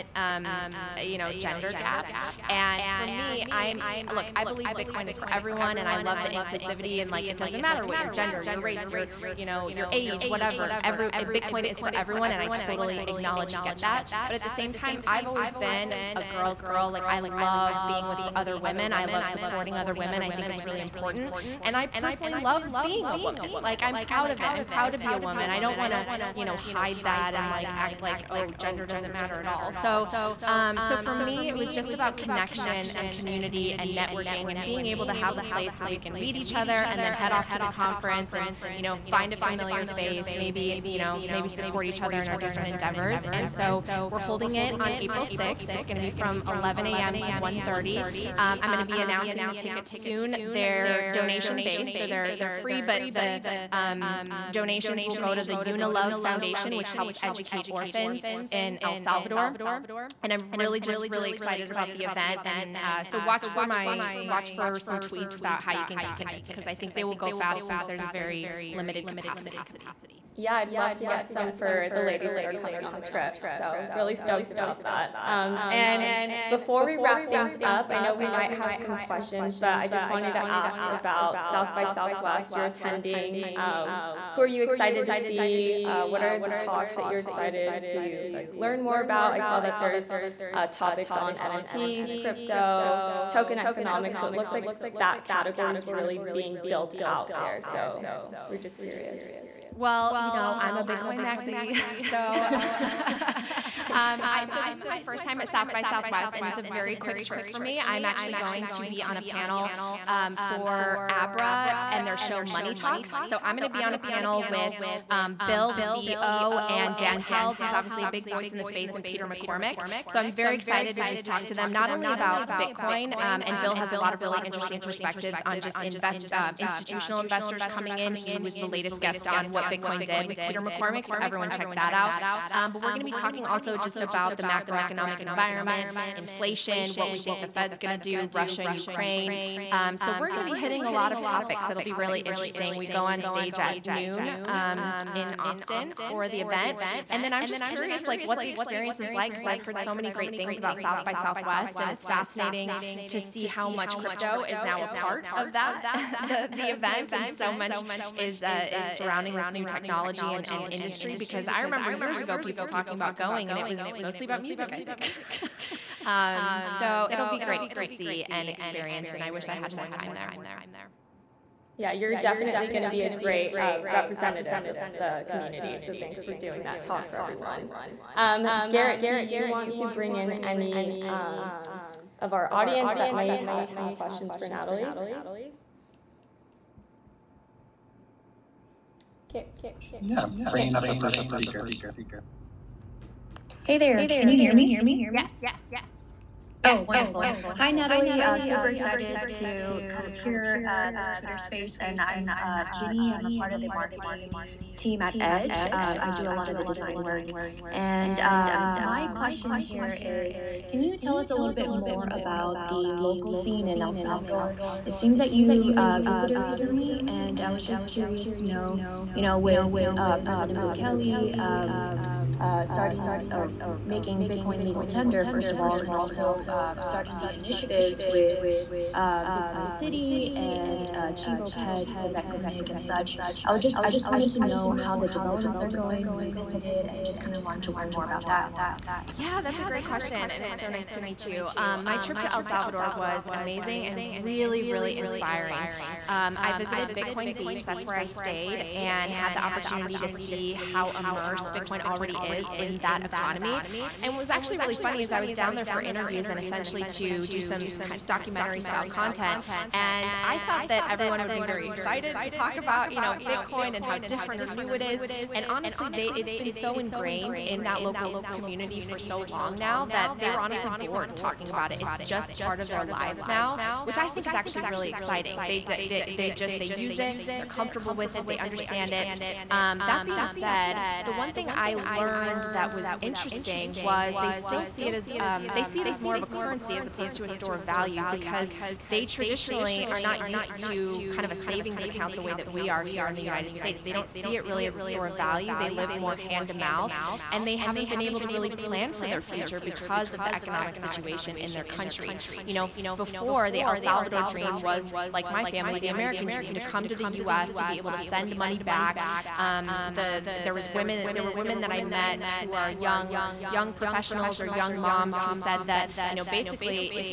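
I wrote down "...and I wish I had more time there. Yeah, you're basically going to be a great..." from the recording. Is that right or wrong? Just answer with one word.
wrong.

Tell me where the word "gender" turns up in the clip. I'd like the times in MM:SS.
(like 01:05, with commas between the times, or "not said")
00:01, 00:08, 00:28.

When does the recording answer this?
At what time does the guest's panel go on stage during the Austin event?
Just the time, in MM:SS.
02:23.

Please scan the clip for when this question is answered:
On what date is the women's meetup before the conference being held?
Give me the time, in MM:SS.
00:44.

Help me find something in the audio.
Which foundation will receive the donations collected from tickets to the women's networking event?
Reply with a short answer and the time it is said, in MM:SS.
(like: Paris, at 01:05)
Unilove Foundation, at 00:55.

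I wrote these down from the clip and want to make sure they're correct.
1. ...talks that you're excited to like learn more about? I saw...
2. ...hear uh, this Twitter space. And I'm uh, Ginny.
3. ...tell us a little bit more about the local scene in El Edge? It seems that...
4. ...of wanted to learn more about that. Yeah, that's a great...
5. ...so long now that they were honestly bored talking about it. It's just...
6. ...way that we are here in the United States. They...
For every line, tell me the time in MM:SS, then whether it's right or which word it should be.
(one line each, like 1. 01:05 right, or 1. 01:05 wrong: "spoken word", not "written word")
1. 01:26 right
2. 03:20 right
3. 03:30 wrong: "Salvador", not "Edge"
4. 03:57 right
5. 04:28 right
6. 04:52 right.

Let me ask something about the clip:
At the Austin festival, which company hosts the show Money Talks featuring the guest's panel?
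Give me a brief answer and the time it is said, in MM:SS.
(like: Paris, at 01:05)
Abra, at 01:51.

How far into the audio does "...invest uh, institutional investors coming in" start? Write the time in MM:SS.
02:05.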